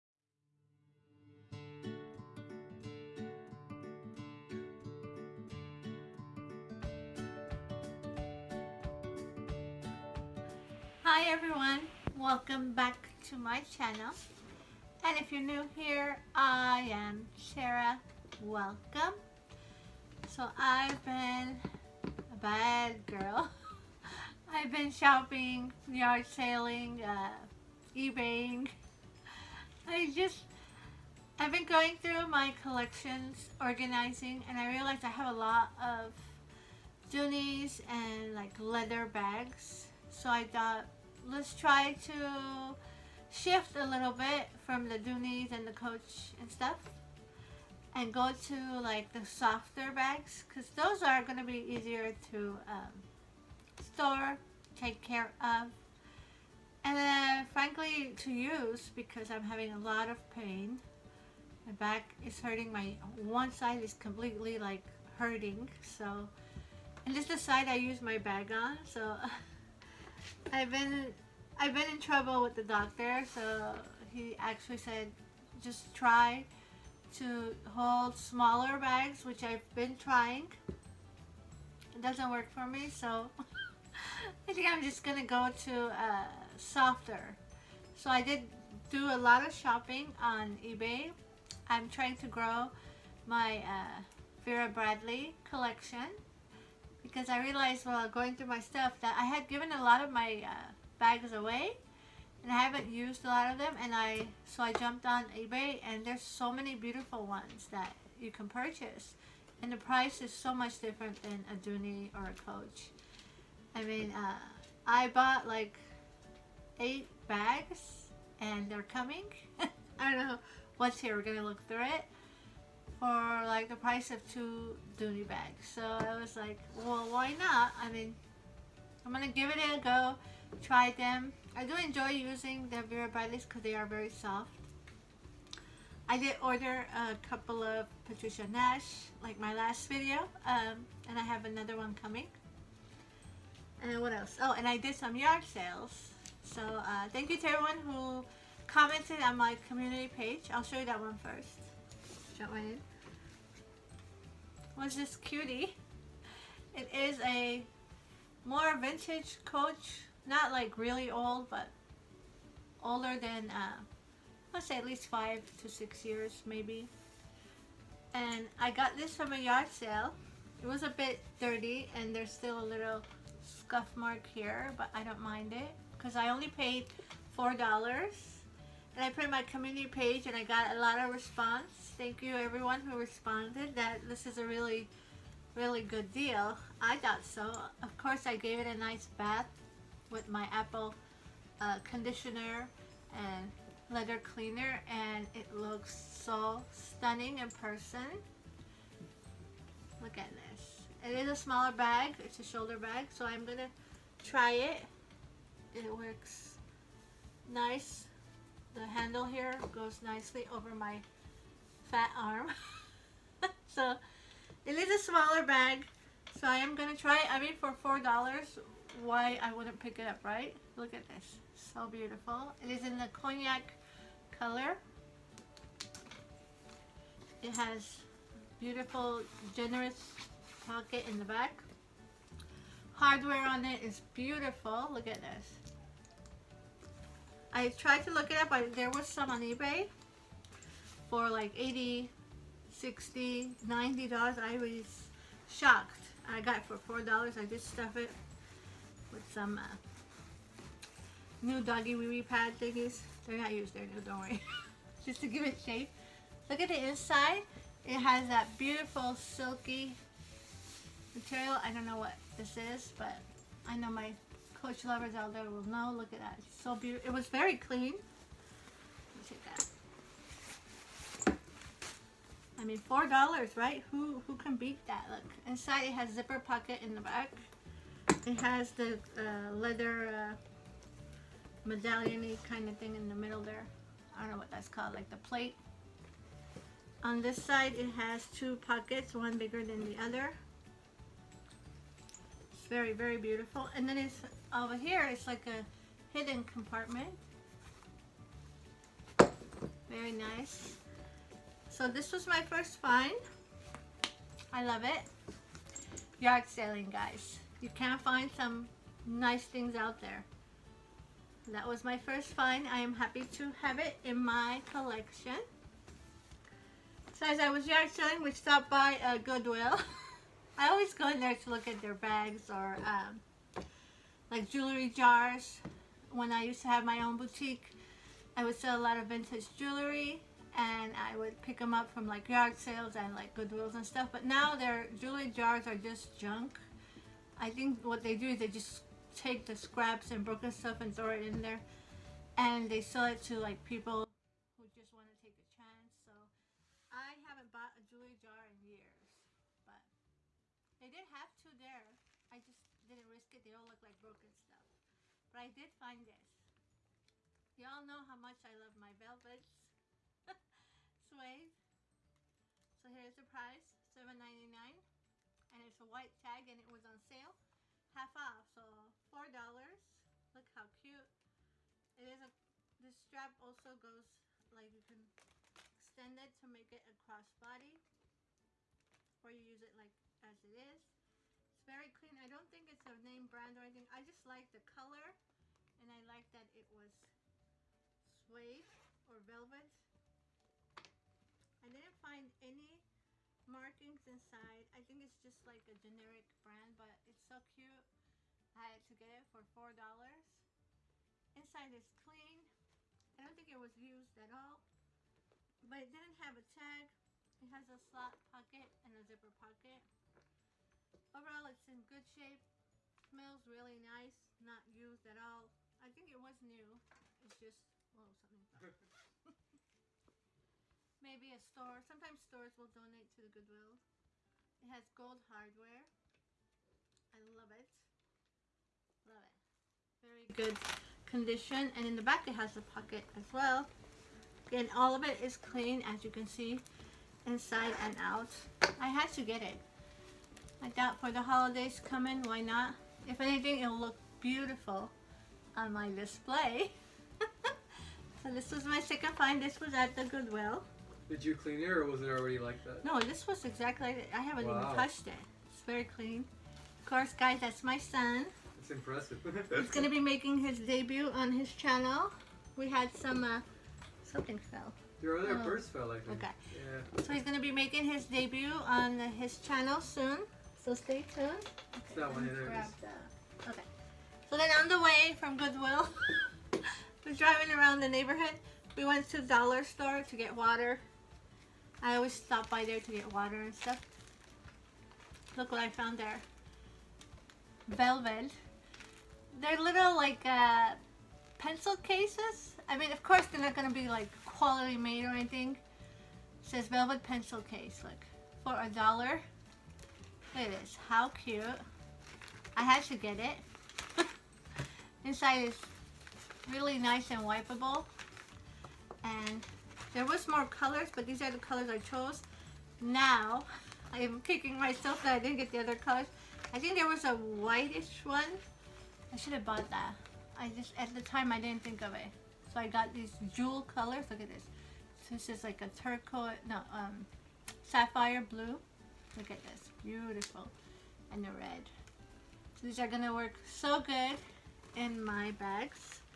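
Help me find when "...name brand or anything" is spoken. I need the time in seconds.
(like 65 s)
382 s.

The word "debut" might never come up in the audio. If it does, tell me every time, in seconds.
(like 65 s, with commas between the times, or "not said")
460 s, 468 s.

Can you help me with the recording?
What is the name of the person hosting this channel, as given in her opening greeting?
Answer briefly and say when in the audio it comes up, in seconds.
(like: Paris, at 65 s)
Tera, at 17 s.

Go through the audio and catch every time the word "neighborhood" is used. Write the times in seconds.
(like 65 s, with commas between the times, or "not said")
477 s.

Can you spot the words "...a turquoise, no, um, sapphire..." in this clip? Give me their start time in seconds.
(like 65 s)
525 s.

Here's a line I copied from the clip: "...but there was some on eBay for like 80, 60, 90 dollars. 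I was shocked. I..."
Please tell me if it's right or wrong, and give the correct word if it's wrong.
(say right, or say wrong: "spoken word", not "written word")
right.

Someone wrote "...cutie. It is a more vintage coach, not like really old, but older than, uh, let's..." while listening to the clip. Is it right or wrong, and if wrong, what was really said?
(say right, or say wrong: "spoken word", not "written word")
right.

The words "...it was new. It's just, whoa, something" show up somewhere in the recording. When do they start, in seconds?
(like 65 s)
416 s.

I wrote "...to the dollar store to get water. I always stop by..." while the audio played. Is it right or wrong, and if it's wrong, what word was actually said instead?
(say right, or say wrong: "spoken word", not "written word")
right.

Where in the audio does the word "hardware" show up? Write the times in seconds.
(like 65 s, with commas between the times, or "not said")
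232 s, 425 s.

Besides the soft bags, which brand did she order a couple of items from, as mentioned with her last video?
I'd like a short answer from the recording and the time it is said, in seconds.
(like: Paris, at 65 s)
Patricia Nash, at 138 s.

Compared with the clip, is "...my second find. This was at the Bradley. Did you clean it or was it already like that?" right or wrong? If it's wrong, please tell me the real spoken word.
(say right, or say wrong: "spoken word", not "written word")
wrong: "Goodwill", not "Bradley".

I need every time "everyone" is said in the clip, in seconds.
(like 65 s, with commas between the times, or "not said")
11 s, 147 s, 182 s.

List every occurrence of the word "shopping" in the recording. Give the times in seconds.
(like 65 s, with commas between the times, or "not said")
24 s, 89 s.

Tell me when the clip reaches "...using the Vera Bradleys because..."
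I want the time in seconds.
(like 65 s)
132 s.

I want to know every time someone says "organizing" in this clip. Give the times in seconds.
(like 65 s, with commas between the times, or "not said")
33 s.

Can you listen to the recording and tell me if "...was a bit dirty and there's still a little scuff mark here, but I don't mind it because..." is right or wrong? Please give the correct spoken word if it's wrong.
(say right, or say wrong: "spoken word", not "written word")
right.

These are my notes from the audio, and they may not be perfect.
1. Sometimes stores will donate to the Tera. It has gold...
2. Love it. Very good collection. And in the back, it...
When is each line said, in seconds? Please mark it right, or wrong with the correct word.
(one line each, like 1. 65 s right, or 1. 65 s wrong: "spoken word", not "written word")
1. 421 s wrong: "Goodwill", not "Tera"
2. 429 s wrong: "condition", not "collection".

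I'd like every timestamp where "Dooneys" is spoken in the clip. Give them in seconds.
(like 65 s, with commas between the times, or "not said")
37 s, 44 s, 111 s, 124 s.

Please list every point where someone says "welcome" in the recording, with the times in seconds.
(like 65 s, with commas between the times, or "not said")
12 s, 18 s.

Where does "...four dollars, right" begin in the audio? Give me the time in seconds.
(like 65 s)
272 s.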